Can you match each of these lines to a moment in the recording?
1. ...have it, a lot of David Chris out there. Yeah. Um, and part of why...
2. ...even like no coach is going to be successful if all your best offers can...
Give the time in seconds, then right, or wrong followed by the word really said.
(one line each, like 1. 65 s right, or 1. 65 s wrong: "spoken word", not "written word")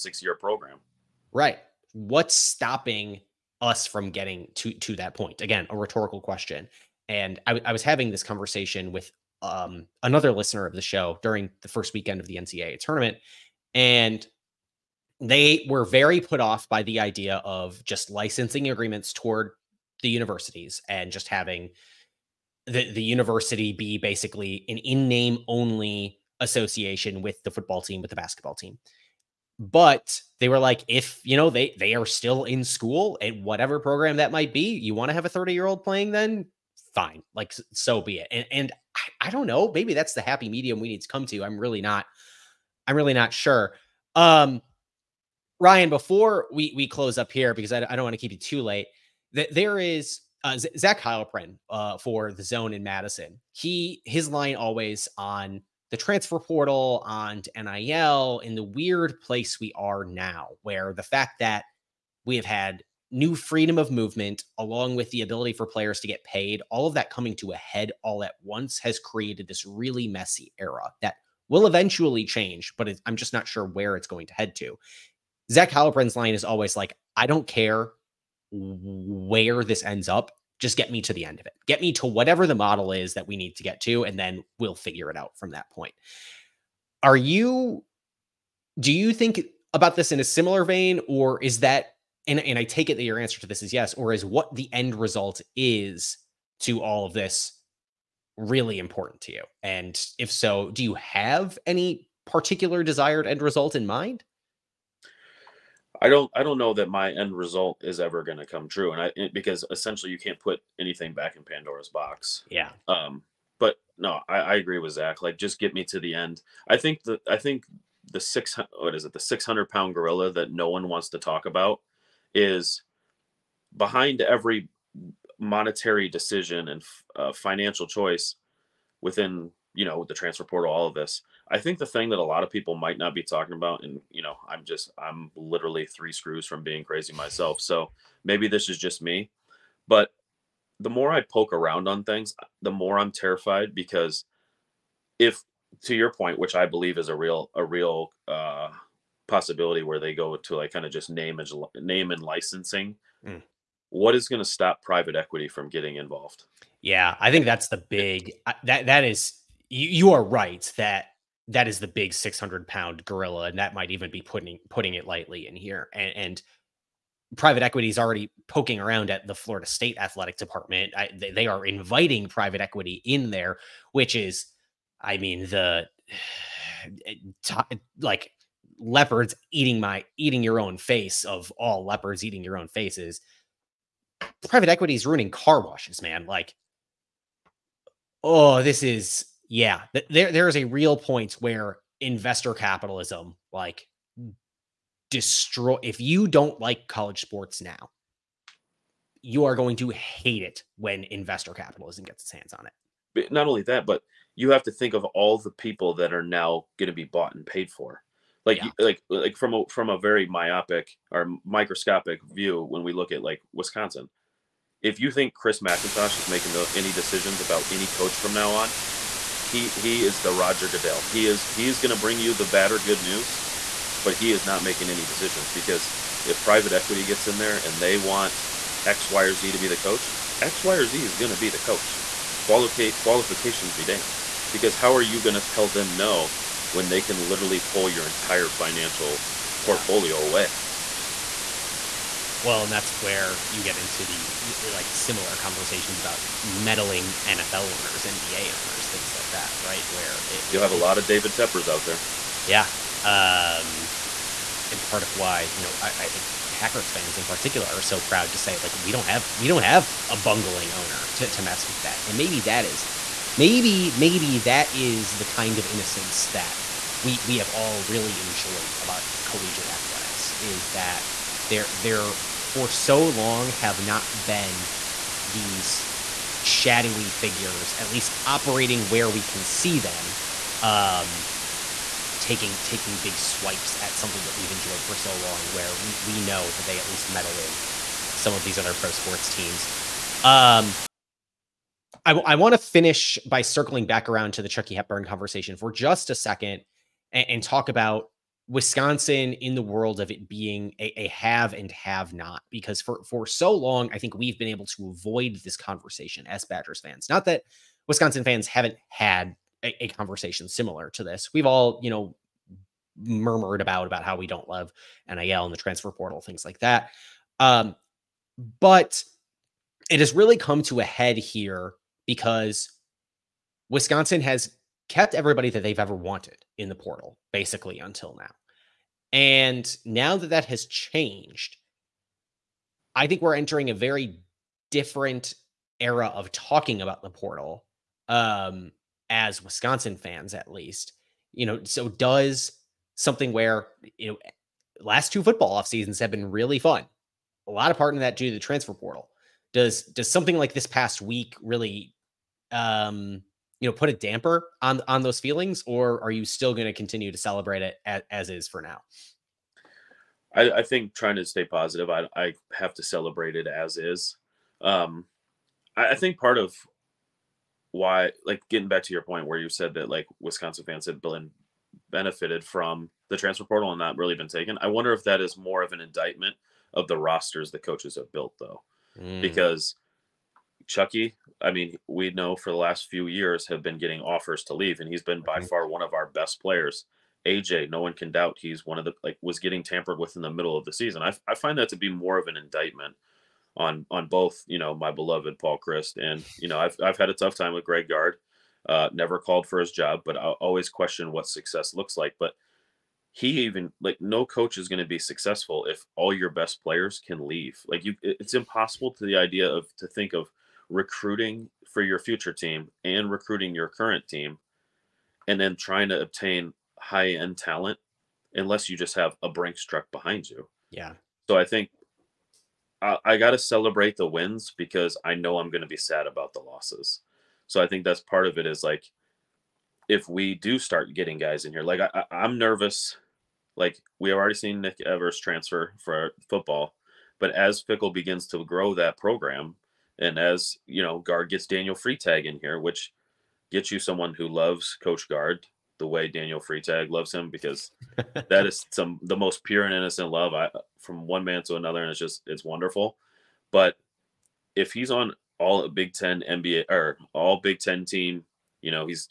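1. 250 s wrong: "Teppers", not "Chris"
2. 403 s wrong: "players", not "offers".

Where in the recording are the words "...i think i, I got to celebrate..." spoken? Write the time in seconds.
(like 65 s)
421 s.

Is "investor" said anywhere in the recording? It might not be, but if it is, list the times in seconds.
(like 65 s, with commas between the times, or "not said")
192 s, 201 s.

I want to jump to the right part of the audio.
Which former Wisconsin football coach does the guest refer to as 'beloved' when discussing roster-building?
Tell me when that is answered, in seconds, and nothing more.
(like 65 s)
395 s.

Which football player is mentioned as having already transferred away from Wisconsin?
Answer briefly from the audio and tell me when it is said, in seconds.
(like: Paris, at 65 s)
Nick Evers, at 434 s.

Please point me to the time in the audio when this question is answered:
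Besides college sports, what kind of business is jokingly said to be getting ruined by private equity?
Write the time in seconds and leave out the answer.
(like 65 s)
185 s.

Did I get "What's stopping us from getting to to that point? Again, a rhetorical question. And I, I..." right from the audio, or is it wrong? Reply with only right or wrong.
right.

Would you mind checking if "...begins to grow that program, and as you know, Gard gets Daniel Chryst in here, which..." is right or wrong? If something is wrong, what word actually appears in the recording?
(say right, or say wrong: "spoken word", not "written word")
wrong: "Freitag", not "Chryst".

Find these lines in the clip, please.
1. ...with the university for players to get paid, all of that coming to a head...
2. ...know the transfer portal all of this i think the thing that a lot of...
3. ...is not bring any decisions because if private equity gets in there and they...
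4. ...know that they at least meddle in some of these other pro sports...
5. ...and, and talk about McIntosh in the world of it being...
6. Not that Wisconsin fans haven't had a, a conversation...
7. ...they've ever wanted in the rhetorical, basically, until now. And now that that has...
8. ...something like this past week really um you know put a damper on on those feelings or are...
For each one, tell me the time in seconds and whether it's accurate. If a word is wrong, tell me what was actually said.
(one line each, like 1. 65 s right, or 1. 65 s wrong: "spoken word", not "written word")
1. 64 s wrong: "ability", not "university"
2. 129 s right
3. 224 s wrong: "making", not "bring"
4. 286 s right
5. 297 s wrong: "Wisconsin", not "McIntosh"
6. 307 s right
7. 325 s wrong: "portal", not "rhetorical"
8. 350 s right.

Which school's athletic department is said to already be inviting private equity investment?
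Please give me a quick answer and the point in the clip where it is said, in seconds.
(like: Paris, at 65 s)
Florida State, at 169 s.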